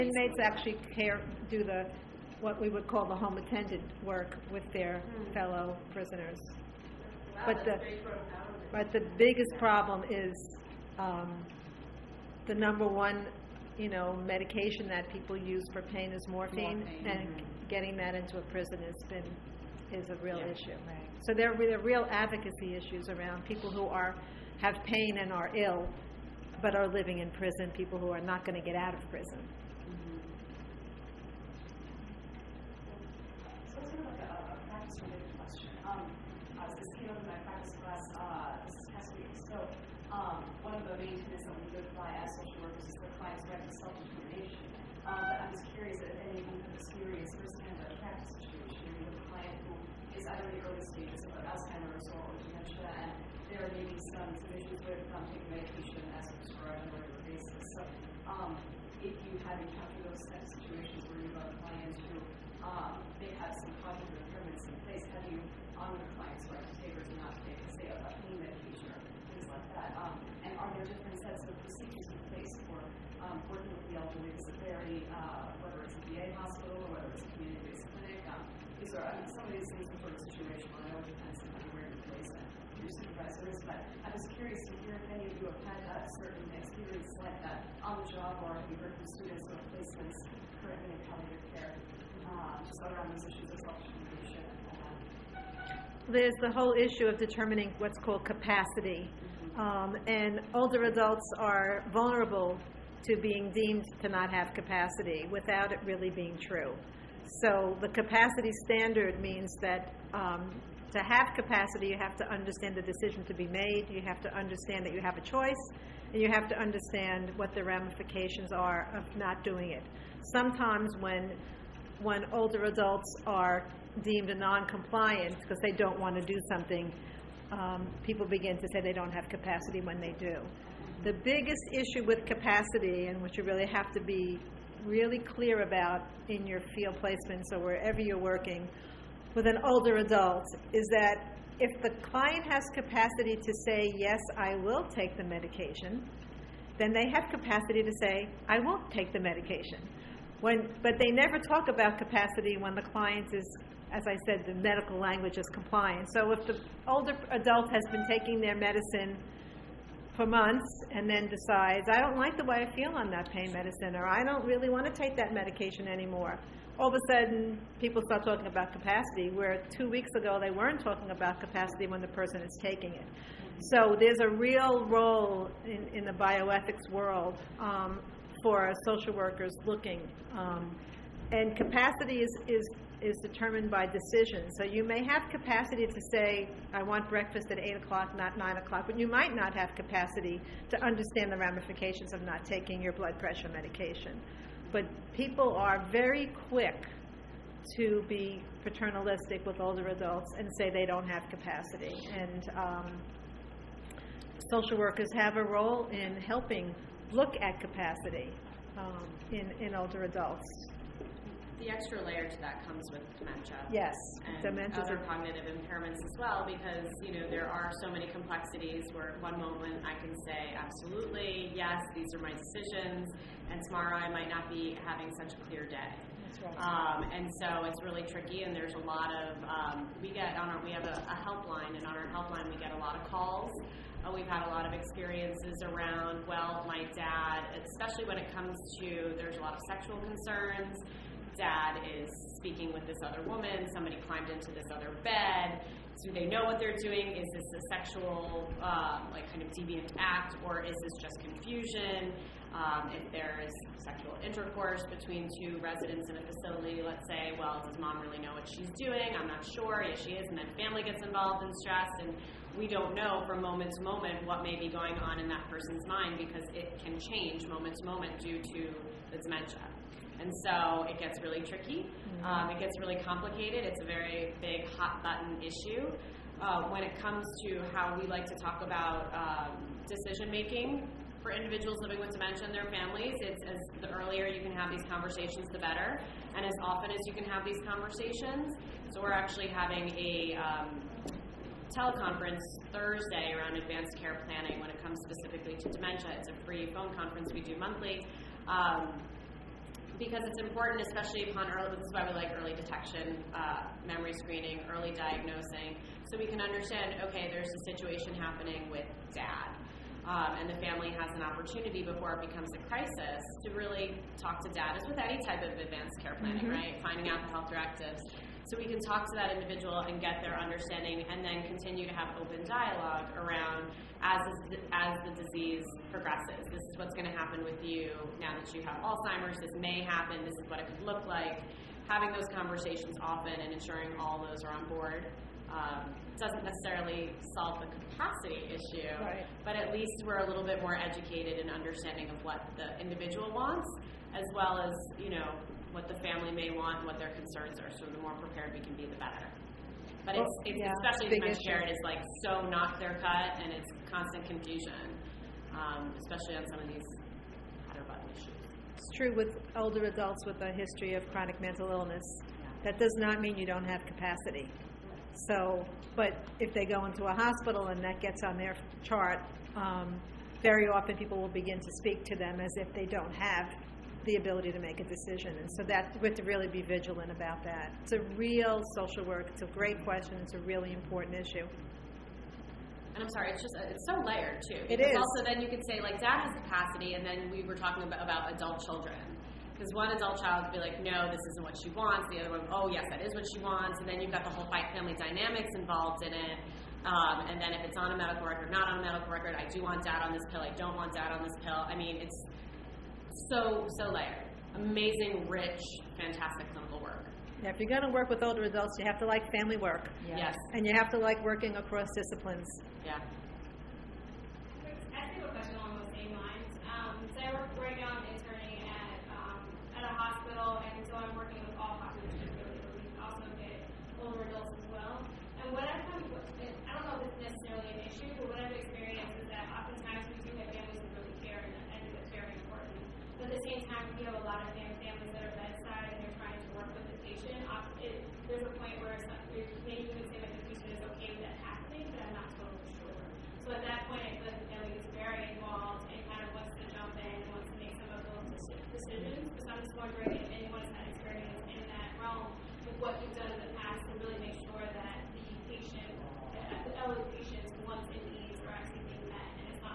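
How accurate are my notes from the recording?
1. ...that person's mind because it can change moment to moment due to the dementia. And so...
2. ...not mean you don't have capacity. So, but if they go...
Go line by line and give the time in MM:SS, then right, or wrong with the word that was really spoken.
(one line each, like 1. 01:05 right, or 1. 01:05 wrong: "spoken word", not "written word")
1. 04:25 right
2. 06:02 right.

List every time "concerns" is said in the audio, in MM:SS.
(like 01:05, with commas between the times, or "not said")
03:59, 05:47.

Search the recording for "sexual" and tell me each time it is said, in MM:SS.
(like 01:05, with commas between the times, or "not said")
03:59, 04:07, 04:13.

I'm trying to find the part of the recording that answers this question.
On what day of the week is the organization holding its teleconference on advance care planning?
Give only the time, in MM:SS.
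04:52.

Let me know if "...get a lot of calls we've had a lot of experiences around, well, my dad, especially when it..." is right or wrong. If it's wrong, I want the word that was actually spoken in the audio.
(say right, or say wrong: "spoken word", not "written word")
right.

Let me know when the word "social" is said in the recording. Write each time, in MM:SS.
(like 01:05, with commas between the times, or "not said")
02:58, 03:24, 06:18.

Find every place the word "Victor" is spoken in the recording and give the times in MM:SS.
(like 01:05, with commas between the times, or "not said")
not said.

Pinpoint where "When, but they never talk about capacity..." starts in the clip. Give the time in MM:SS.
02:30.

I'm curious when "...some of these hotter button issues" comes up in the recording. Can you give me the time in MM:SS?
05:56.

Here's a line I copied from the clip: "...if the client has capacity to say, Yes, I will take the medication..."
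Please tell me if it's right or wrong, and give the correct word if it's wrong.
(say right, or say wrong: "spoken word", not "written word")
right.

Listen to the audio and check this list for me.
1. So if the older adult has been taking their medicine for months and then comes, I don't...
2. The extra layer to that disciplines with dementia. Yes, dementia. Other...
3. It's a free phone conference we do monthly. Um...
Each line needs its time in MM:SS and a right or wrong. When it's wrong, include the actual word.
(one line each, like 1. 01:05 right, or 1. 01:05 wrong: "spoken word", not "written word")
1. 02:36 wrong: "decides", not "comes"
2. 03:31 wrong: "comes", not "disciplines"
3. 04:56 right.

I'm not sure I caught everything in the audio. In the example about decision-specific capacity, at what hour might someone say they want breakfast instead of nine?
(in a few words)
8 o'clock.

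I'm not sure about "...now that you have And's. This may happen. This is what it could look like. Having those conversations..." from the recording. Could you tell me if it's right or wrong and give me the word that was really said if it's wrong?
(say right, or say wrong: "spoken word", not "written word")
wrong: "Alzheimer", not "And".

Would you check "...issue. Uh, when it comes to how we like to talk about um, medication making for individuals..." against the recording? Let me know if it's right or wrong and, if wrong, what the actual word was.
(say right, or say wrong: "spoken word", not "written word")
wrong: "decision", not "medication".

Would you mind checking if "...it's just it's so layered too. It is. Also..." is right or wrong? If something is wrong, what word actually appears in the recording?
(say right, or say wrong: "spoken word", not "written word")
right.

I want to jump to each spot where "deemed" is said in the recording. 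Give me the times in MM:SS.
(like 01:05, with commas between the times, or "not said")
01:43, 02:04.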